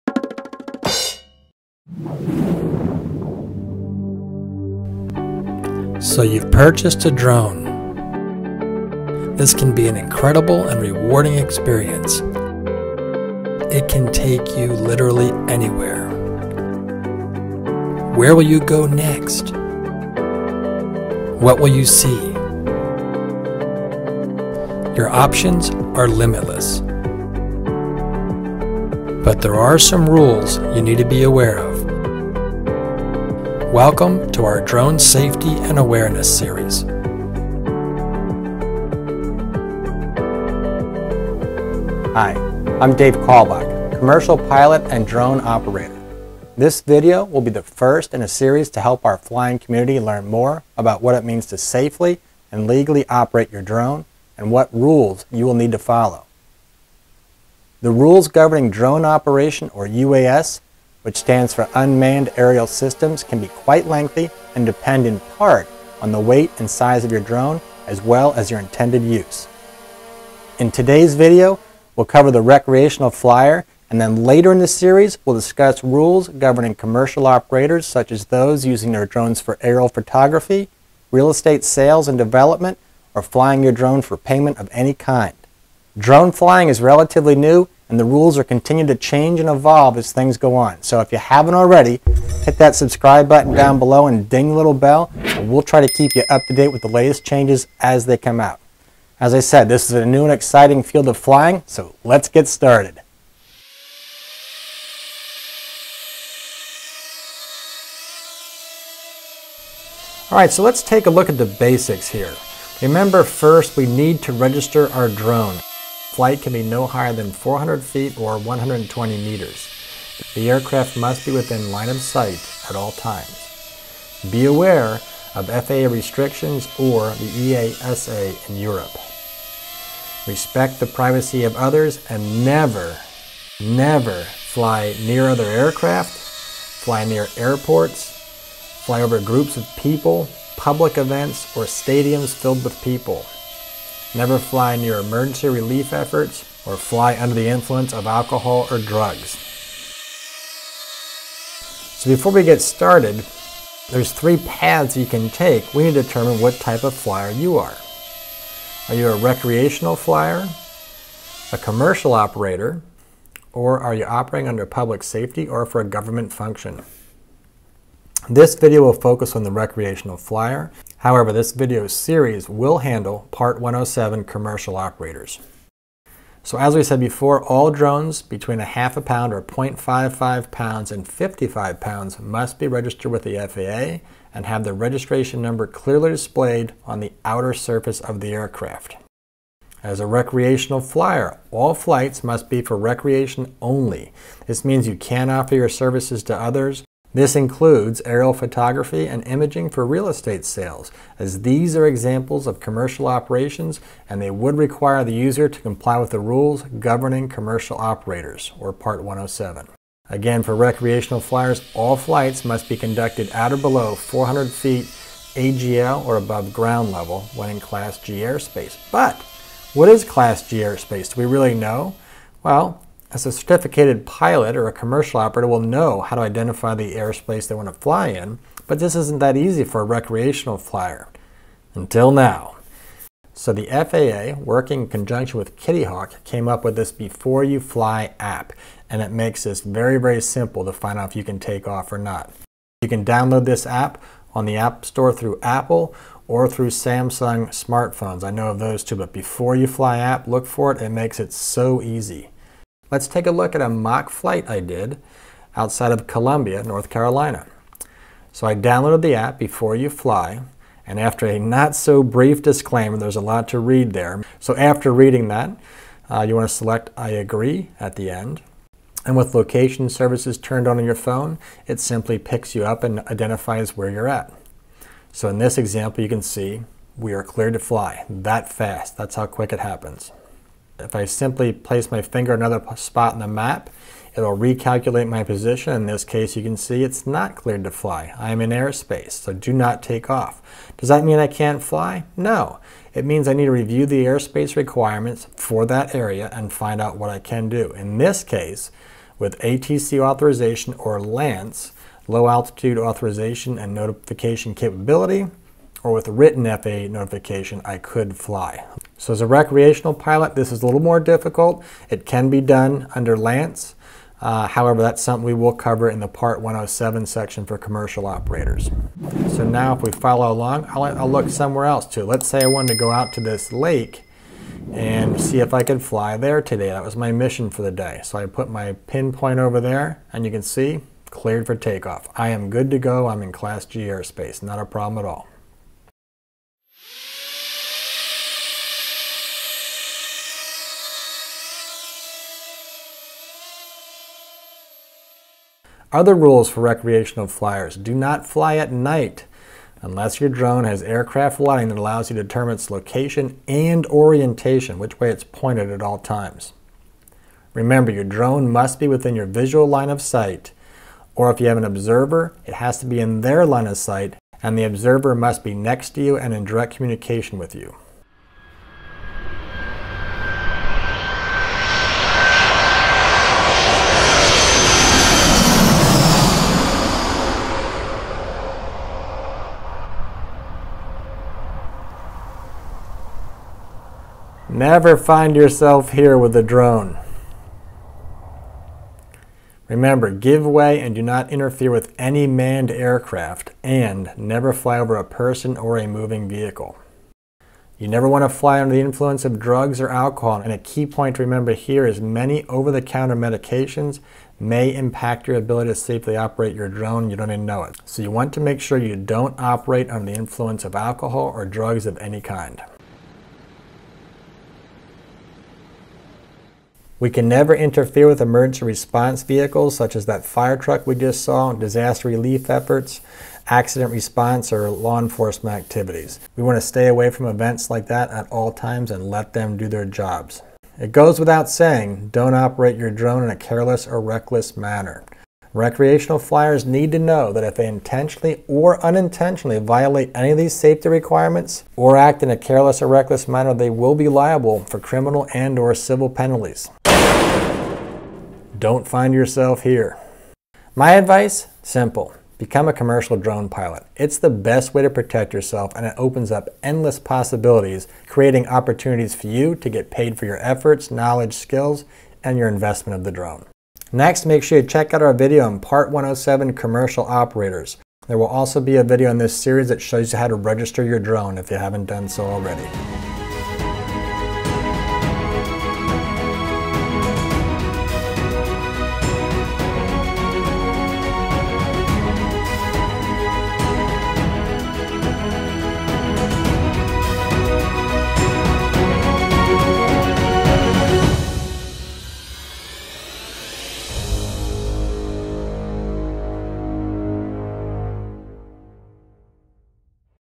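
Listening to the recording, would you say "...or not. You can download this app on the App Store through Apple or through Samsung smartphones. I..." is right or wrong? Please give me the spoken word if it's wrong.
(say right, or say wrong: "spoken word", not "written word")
right.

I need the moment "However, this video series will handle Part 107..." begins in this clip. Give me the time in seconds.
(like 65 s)
170 s.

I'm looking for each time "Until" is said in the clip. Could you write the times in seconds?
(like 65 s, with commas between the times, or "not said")
231 s.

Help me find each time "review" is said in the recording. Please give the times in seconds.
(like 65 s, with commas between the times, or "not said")
293 s.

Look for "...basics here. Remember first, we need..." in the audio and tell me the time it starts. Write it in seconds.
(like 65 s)
111 s.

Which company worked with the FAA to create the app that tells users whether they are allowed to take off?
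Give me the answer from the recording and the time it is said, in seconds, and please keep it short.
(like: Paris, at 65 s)
Kitty Hawk, at 235 s.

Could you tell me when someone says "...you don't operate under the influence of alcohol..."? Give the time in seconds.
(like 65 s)
408 s.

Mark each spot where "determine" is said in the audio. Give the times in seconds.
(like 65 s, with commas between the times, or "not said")
156 s, 352 s.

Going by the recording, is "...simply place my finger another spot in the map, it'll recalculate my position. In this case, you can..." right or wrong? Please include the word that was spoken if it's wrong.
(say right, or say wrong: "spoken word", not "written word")
right.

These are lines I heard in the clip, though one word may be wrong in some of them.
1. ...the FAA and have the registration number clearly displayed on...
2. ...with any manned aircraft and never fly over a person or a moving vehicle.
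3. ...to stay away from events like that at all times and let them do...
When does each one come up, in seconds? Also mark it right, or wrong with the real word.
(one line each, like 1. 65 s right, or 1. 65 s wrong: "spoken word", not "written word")
1. 183 s right
2. 391 s right
3. 426 s right.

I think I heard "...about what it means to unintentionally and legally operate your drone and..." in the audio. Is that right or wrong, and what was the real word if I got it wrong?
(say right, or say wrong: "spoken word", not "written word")
wrong: "safely", not "unintentionally".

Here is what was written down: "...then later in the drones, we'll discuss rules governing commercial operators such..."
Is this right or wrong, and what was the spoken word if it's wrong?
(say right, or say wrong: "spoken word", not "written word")
wrong: "series", not "drones".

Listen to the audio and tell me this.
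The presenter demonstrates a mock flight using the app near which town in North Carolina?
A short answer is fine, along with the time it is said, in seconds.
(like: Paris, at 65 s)
Columbia, at 256 s.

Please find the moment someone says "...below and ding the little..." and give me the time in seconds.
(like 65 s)
93 s.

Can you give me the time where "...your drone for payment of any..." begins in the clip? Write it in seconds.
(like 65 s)
83 s.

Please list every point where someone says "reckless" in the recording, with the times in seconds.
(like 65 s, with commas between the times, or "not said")
433 s, 442 s.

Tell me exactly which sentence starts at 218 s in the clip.
But what is Class G airspace?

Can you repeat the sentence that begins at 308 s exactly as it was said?
So as a recreational pilot, this is a little more difficult.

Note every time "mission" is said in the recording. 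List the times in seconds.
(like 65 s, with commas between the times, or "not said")
327 s.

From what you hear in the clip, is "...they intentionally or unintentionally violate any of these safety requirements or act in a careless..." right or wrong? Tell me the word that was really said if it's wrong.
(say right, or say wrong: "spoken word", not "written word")
right.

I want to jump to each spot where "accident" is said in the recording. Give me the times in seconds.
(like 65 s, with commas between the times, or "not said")
423 s.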